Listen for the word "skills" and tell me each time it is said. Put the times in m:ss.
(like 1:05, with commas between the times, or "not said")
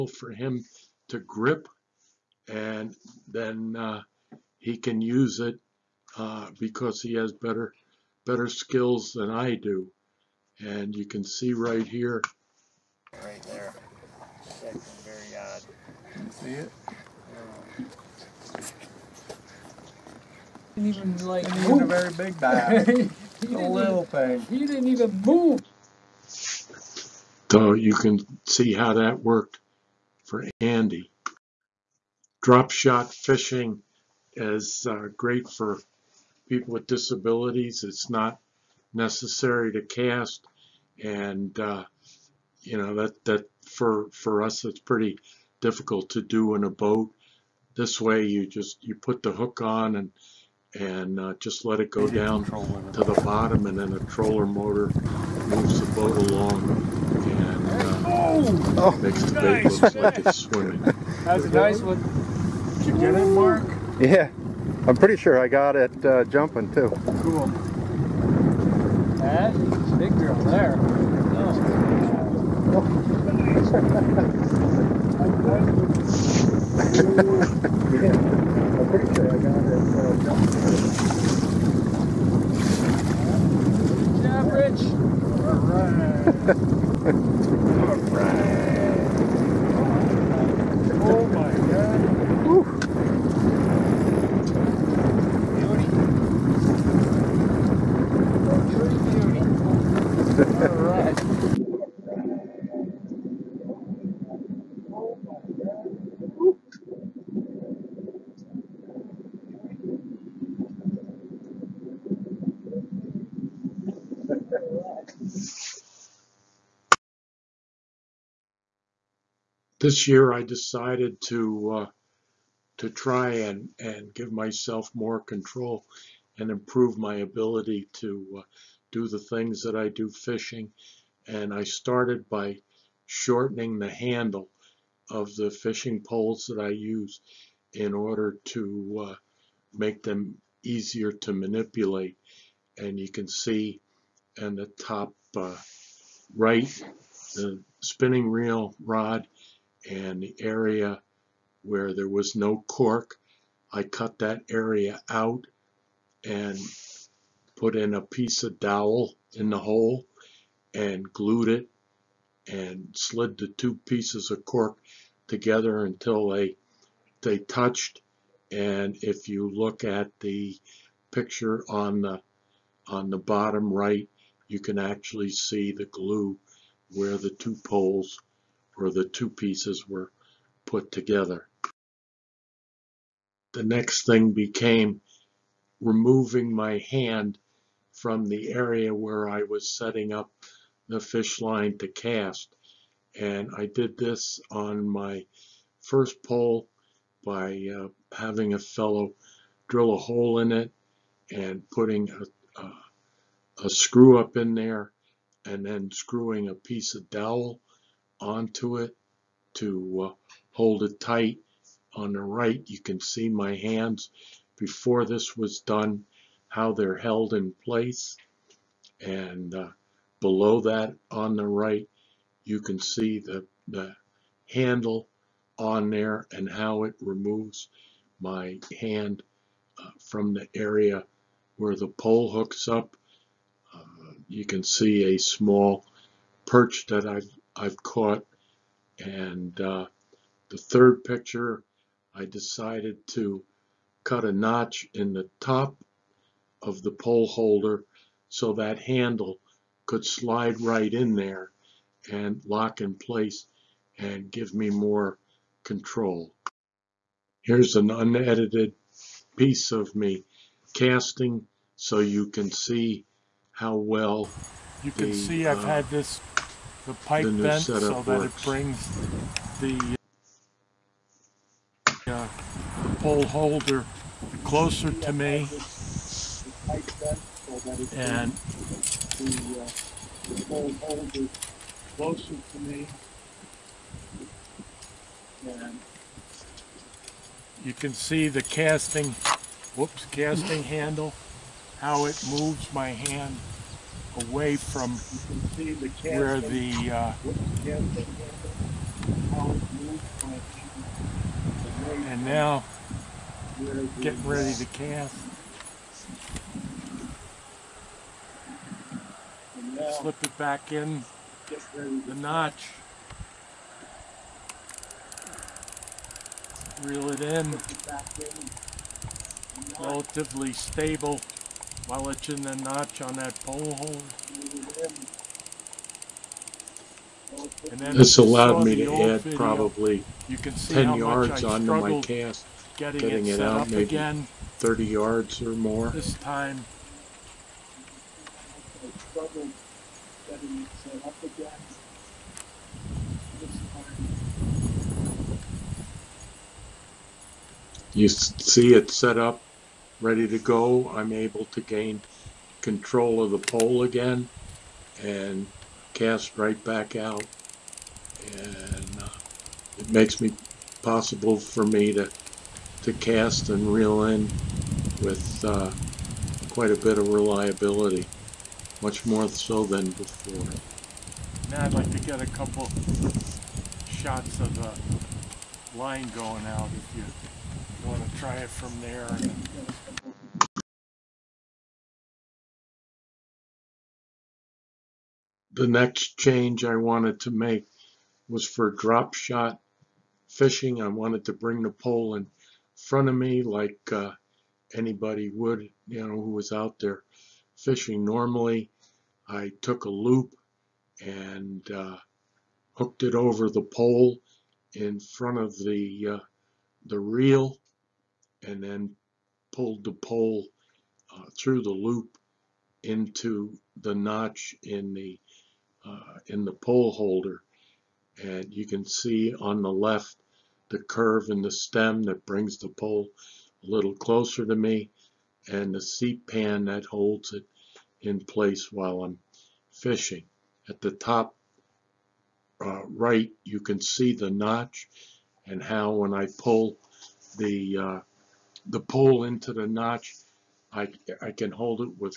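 0:08.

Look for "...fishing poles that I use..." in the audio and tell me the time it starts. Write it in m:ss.
2:15.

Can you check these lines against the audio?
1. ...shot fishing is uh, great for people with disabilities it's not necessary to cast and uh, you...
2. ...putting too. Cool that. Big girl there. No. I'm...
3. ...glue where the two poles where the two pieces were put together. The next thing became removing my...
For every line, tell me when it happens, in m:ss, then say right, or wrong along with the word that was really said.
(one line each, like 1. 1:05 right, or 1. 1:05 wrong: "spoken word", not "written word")
1. 0:32 right
2. 1:06 wrong: "jumping", not "putting"
3. 2:55 right.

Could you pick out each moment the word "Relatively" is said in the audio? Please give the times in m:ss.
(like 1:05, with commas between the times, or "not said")
5:19.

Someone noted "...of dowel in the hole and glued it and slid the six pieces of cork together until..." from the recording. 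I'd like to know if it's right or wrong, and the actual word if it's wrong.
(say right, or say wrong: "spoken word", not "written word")
wrong: "two", not "six".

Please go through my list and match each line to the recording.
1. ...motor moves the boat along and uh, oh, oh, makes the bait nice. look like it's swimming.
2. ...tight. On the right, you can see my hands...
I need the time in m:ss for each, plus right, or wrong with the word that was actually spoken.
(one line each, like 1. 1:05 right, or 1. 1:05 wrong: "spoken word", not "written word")
1. 0:54 right
2. 3:30 right.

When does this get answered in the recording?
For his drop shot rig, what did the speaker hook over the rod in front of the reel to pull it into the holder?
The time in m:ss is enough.
6:39.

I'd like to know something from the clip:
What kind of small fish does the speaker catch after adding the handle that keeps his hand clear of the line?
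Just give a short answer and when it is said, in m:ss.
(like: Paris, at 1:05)
perch, at 3:55.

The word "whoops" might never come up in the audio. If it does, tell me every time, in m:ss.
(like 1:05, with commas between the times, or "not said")
4:49.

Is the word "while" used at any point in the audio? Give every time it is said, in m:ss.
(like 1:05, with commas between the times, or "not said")
5:21, 7:08.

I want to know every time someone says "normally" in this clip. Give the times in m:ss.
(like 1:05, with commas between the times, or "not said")
6:38.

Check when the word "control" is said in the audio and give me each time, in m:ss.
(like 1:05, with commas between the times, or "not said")
2:05, 4:15, 5:52.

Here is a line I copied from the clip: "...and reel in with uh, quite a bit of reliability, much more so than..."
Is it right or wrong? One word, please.
right.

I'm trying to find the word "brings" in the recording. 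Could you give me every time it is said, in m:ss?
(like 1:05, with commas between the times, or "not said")
4:28, 6:31, 7:02.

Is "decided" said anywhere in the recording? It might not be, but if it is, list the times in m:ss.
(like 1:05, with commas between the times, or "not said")
2:00, 4:02.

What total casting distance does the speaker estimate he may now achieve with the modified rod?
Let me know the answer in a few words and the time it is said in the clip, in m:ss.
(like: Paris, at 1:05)
30 yards or more, at 5:34.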